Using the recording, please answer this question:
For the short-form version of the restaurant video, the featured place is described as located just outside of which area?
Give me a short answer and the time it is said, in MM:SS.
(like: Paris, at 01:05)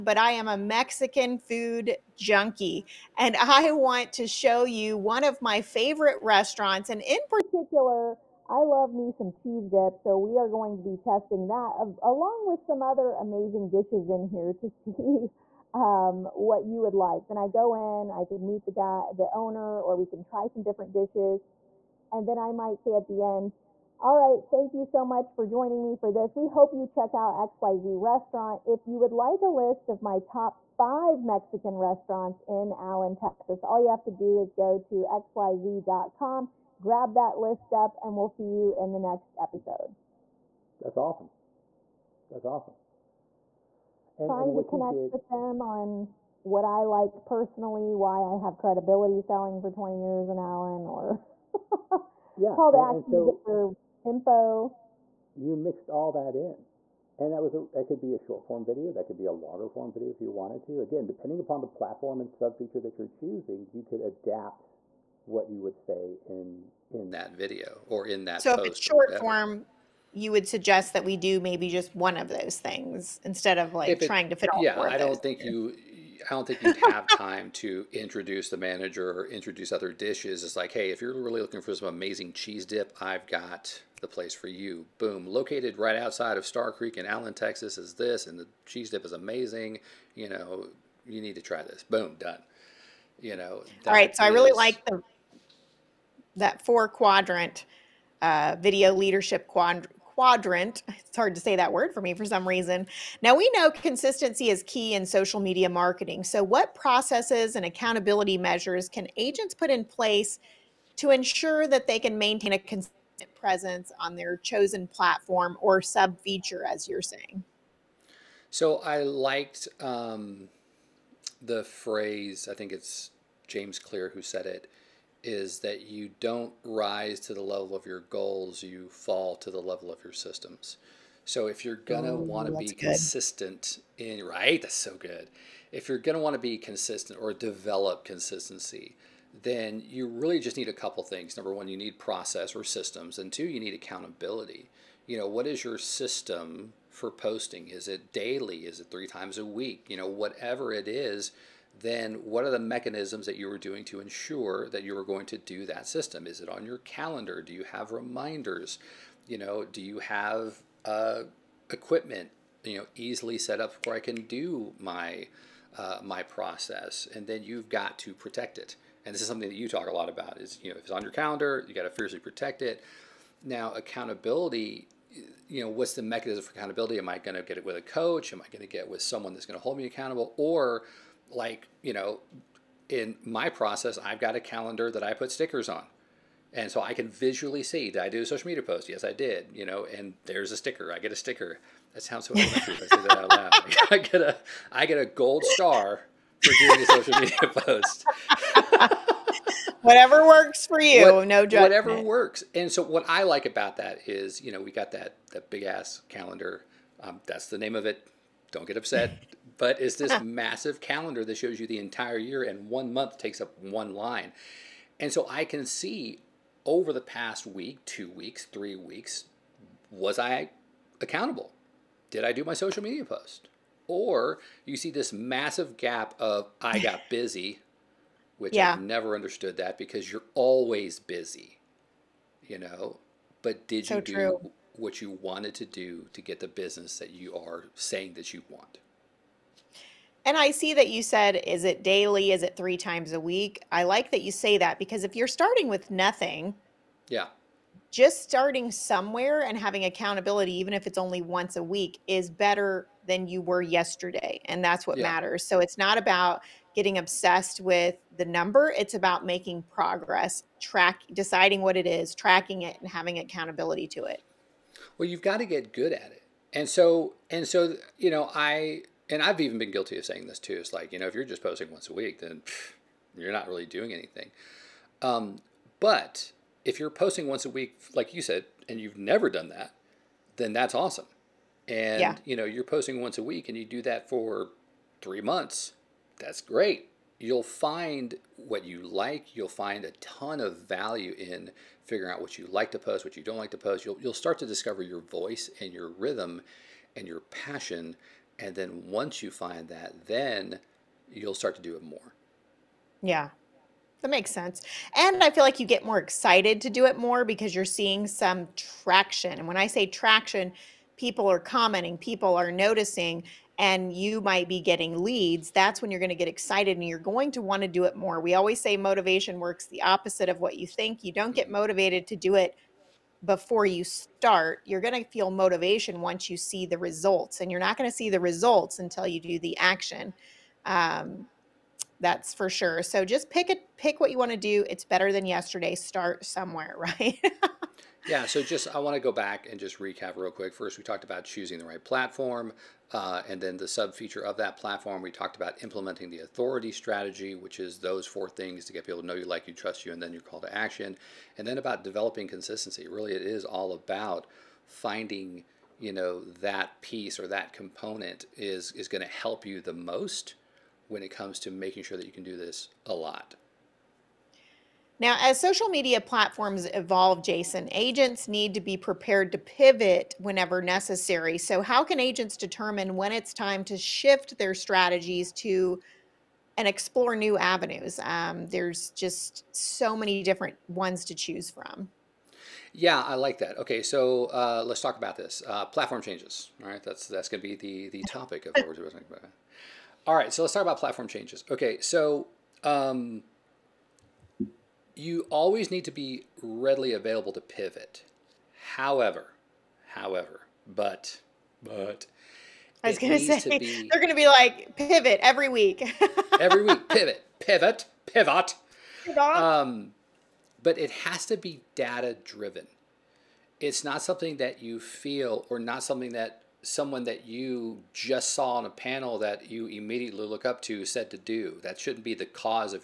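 Star Creek, at 01:26.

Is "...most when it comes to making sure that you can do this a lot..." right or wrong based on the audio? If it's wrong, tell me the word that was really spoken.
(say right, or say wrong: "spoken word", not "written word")
right.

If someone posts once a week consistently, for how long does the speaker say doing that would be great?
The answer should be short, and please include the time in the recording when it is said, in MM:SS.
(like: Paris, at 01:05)
3 months, at 04:45.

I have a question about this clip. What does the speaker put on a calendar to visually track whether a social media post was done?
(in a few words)
stickers.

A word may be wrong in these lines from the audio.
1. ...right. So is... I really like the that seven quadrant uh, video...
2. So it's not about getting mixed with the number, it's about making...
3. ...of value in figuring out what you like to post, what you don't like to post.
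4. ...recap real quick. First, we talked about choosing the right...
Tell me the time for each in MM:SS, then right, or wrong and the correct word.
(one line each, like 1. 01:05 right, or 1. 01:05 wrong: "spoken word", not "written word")
1. 01:33 wrong: "four", not "seven"
2. 04:15 wrong: "obsessed", not "mixed"
3. 04:50 right
4. 05:39 right.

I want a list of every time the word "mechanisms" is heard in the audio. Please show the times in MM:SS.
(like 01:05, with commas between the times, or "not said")
02:32, 02:56.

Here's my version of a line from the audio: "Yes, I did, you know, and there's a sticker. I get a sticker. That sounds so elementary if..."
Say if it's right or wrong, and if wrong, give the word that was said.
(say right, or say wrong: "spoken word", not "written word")
right.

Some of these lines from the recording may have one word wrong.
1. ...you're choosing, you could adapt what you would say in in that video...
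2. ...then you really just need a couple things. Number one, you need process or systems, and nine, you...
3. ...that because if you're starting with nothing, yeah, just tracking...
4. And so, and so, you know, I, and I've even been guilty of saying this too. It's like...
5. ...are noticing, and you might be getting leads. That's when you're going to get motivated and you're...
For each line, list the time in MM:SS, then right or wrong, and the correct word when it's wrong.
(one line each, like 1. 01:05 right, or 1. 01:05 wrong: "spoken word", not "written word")
1. 01:02 right
2. 02:19 wrong: "two", not "nine"
3. 04:04 wrong: "starting", not "tracking"
4. 04:26 right
5. 05:12 wrong: "excited", not "motivated".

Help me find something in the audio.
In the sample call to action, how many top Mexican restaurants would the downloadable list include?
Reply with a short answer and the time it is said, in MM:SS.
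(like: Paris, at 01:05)
5, at 00:30.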